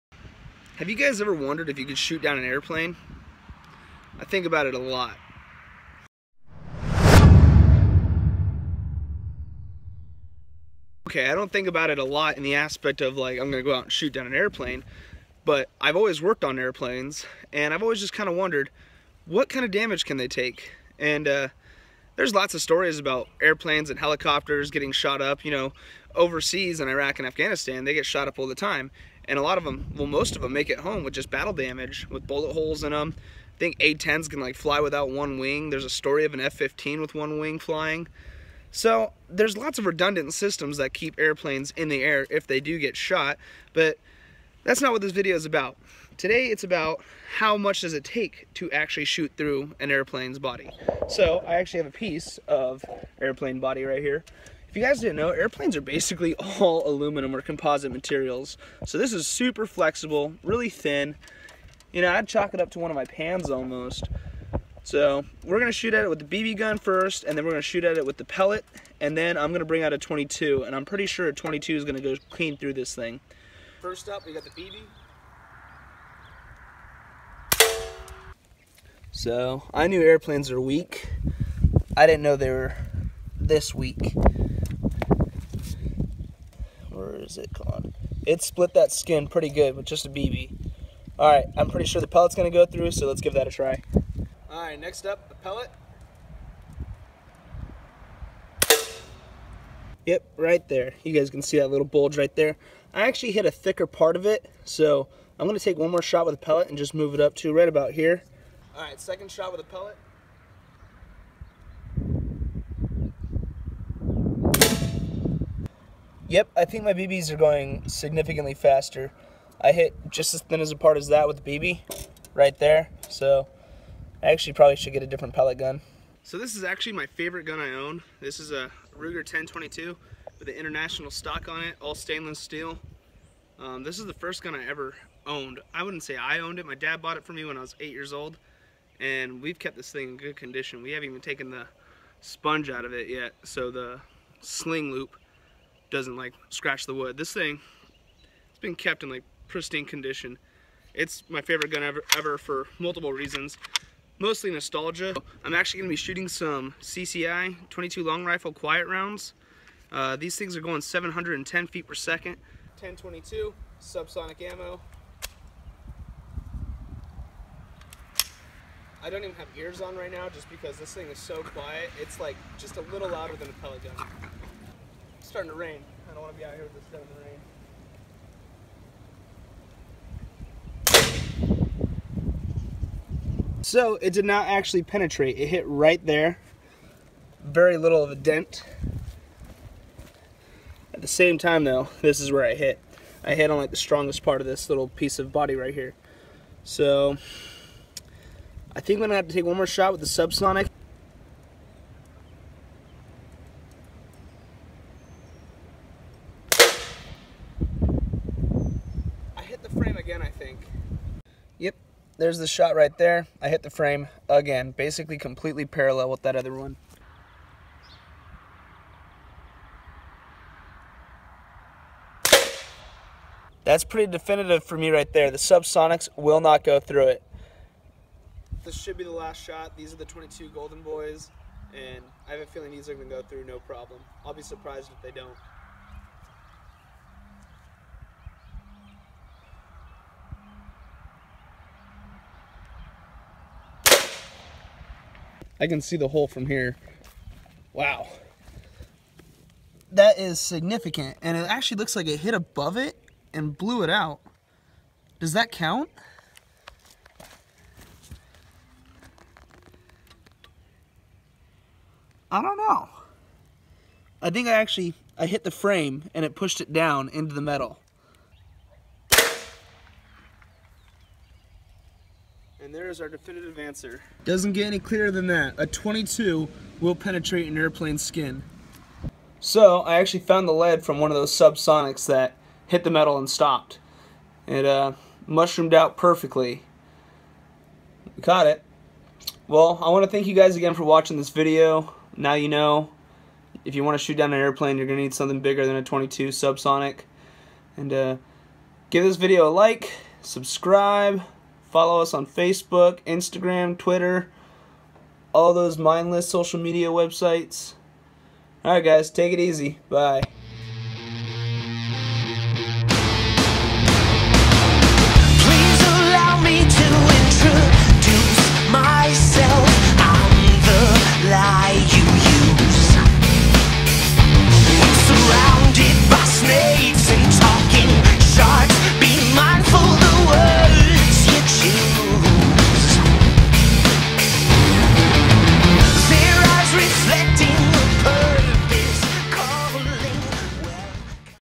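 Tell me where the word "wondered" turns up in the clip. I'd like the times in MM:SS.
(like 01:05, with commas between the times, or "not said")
00:01, 00:18.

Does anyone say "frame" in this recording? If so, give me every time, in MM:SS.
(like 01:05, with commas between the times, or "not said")
03:33, 04:25.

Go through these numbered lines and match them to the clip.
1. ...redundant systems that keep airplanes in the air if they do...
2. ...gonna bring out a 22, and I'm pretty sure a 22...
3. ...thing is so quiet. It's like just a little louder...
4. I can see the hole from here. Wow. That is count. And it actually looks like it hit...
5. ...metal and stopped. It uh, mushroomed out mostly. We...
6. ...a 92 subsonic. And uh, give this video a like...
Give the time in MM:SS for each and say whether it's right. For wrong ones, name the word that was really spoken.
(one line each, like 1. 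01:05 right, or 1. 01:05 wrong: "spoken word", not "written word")
1. 00:39 right
2. 01:09 right
3. 02:50 right
4. 04:05 wrong: "significant", not "count"
5. 04:42 wrong: "perfectly", not "mostly"
6. 04:55 wrong: "22", not "92".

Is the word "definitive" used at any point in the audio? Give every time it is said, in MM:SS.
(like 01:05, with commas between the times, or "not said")
03:44, 04:33.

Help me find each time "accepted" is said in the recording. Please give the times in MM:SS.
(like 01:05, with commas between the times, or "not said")
not said.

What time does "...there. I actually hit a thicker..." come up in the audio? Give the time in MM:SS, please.
01:42.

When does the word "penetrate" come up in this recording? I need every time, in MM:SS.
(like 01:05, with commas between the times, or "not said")
03:04, 04:36.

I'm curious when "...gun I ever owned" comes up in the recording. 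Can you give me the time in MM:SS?
02:14.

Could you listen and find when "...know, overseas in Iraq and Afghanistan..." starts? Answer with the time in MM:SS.
00:25.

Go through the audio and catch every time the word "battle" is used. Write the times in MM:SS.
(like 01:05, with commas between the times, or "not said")
00:31.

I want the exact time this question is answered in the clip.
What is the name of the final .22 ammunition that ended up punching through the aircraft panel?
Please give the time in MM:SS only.
03:50.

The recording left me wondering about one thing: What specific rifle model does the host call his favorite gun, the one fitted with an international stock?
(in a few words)
Ruger 10/22.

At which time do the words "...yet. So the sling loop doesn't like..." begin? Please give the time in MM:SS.
02:23.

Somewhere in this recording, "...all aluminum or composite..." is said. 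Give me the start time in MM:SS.
00:56.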